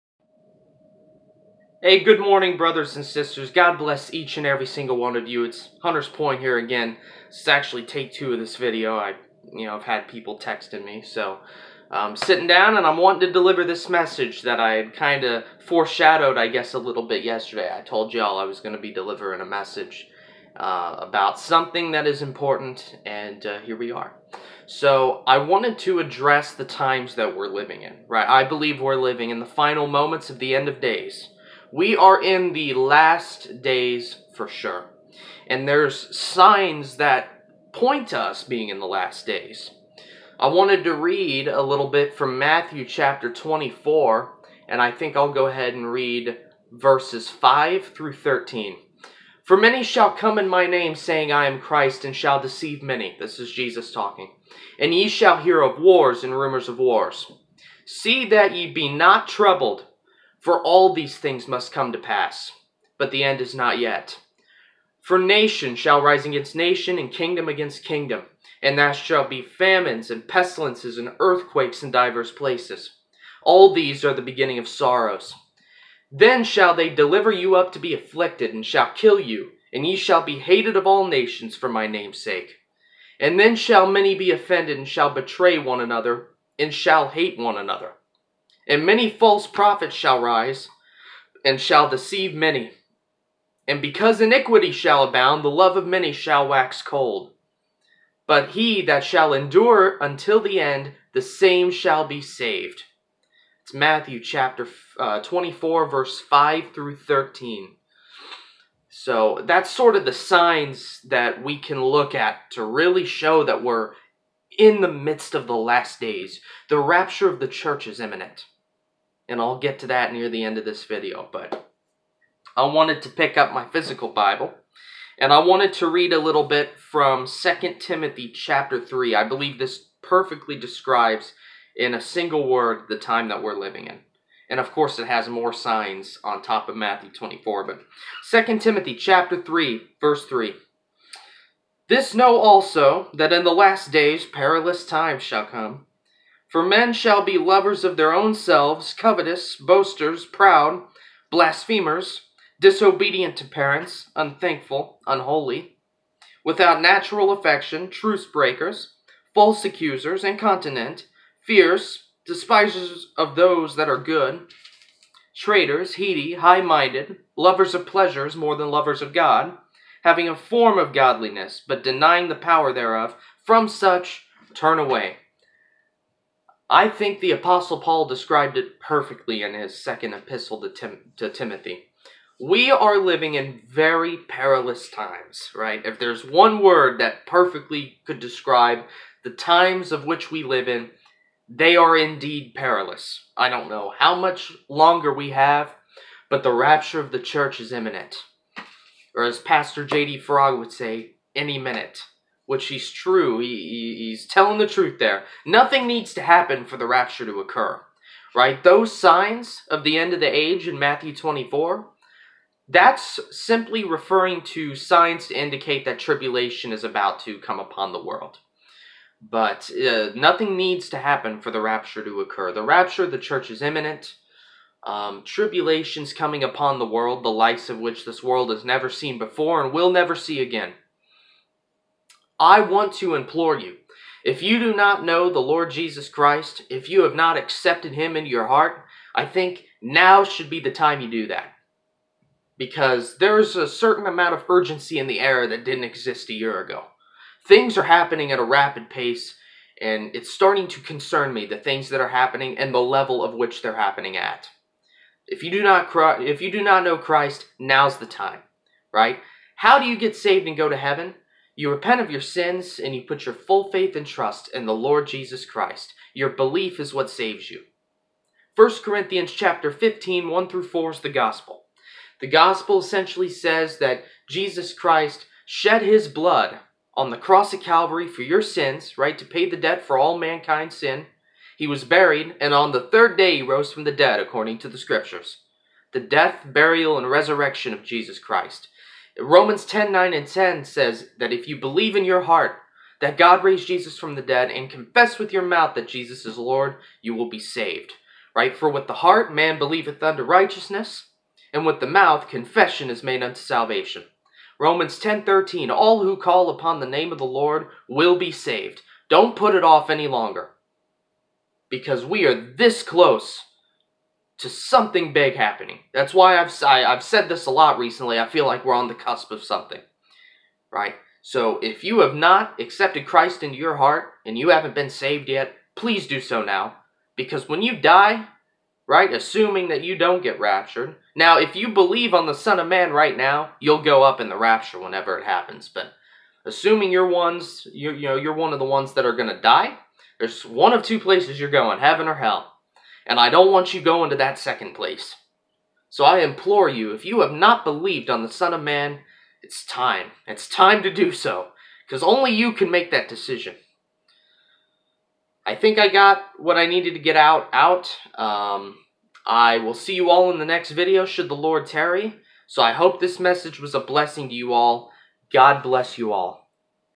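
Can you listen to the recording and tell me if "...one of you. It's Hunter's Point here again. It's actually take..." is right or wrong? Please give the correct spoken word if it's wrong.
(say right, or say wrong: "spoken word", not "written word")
right.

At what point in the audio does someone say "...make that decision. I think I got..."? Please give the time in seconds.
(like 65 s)
352 s.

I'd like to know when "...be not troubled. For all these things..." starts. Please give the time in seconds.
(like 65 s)
58 s.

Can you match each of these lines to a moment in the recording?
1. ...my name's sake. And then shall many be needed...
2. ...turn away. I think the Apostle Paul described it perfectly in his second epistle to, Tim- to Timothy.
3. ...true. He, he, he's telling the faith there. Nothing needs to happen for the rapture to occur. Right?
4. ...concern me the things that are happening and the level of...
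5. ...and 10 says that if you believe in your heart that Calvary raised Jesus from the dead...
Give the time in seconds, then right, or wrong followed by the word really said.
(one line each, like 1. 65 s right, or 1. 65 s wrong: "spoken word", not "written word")
1. 81 s wrong: "offended", not "needed"
2. 174 s right
3. 202 s wrong: "truth", not "faith"
4. 250 s right
5. 290 s wrong: "God", not "Calvary".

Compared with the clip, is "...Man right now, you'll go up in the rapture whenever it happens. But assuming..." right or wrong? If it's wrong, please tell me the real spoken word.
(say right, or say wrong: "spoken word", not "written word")
right.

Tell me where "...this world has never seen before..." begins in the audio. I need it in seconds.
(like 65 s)
228 s.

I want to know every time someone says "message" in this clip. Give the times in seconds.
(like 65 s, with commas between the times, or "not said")
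13 s, 19 s, 363 s.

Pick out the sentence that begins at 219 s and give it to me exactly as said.
But uh, nothing needs to happen for the rapture to occur.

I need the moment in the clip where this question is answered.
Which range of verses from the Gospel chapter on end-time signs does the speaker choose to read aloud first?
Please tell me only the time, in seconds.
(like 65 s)
46 s.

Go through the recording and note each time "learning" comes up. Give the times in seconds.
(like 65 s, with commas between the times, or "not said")
not said.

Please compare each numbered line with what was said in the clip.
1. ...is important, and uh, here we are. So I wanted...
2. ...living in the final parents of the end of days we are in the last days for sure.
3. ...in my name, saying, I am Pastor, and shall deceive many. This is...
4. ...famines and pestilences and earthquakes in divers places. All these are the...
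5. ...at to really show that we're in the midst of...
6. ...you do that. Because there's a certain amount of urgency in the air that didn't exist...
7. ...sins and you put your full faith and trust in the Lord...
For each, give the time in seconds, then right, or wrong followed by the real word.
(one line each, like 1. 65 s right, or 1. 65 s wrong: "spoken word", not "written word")
1. 22 s right
2. 29 s wrong: "moments", not "parents"
3. 50 s wrong: "Christ", not "Pastor"
4. 69 s right
5. 112 s right
6. 241 s right
7. 262 s right.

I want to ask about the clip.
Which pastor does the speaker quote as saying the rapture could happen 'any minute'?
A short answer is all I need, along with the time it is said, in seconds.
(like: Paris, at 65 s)
J.D. Farag, at 199 s.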